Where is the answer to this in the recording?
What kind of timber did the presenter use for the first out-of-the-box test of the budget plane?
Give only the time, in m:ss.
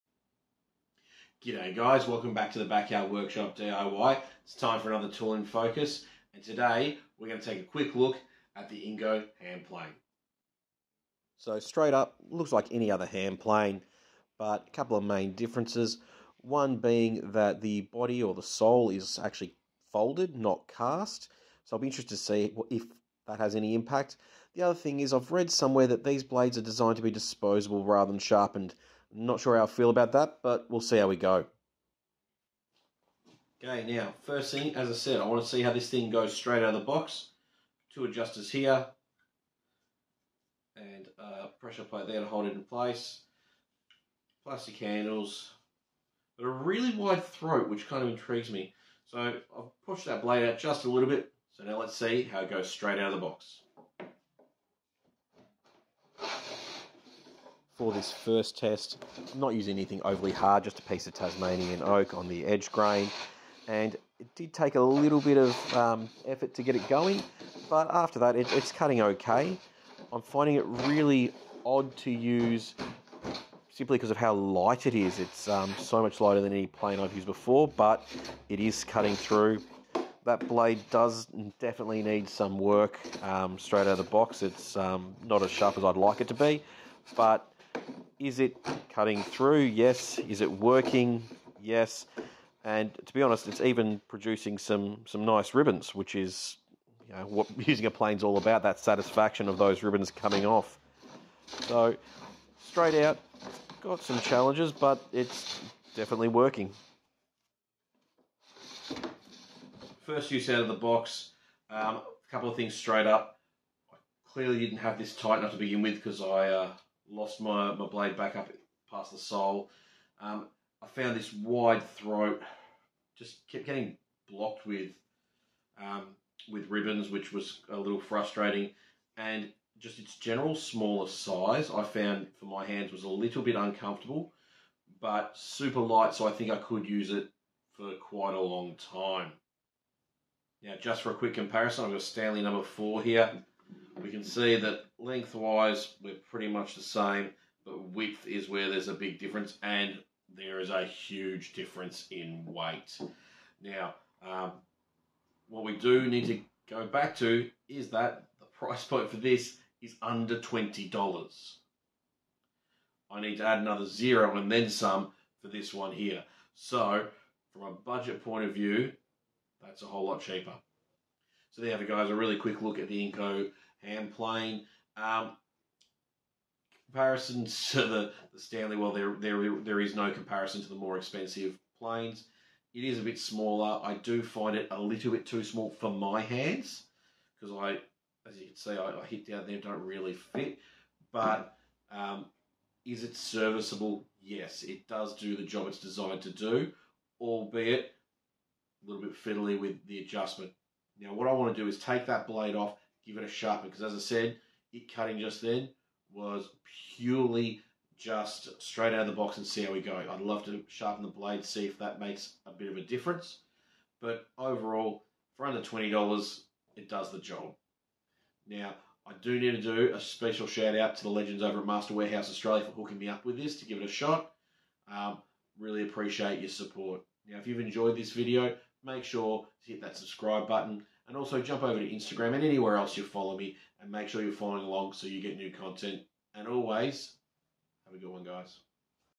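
1:01.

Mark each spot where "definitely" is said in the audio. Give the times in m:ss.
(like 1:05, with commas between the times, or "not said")
1:21, 1:45.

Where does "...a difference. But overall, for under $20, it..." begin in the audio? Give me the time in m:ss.
3:32.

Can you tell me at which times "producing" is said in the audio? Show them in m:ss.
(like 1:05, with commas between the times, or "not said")
1:34.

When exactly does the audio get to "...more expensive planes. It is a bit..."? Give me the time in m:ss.
3:00.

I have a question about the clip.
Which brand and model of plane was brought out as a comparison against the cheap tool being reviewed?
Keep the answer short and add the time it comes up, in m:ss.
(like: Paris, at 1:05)
Stanley number four, at 2:22.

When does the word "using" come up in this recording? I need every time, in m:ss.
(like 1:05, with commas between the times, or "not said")
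0:59, 1:37.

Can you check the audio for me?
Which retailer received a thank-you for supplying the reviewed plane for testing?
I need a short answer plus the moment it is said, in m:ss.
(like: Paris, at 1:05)
Master Warehouse Australia, at 3:41.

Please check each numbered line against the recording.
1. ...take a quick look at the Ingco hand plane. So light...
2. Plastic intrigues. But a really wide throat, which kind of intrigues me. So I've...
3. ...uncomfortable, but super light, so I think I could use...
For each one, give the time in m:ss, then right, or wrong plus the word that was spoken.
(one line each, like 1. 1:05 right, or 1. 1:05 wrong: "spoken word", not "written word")
1. 0:07 wrong: "straight", not "light"
2. 0:44 wrong: "handles", not "intrigues"
3. 2:13 right.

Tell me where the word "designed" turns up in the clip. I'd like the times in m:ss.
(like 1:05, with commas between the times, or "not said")
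0:26, 3:15.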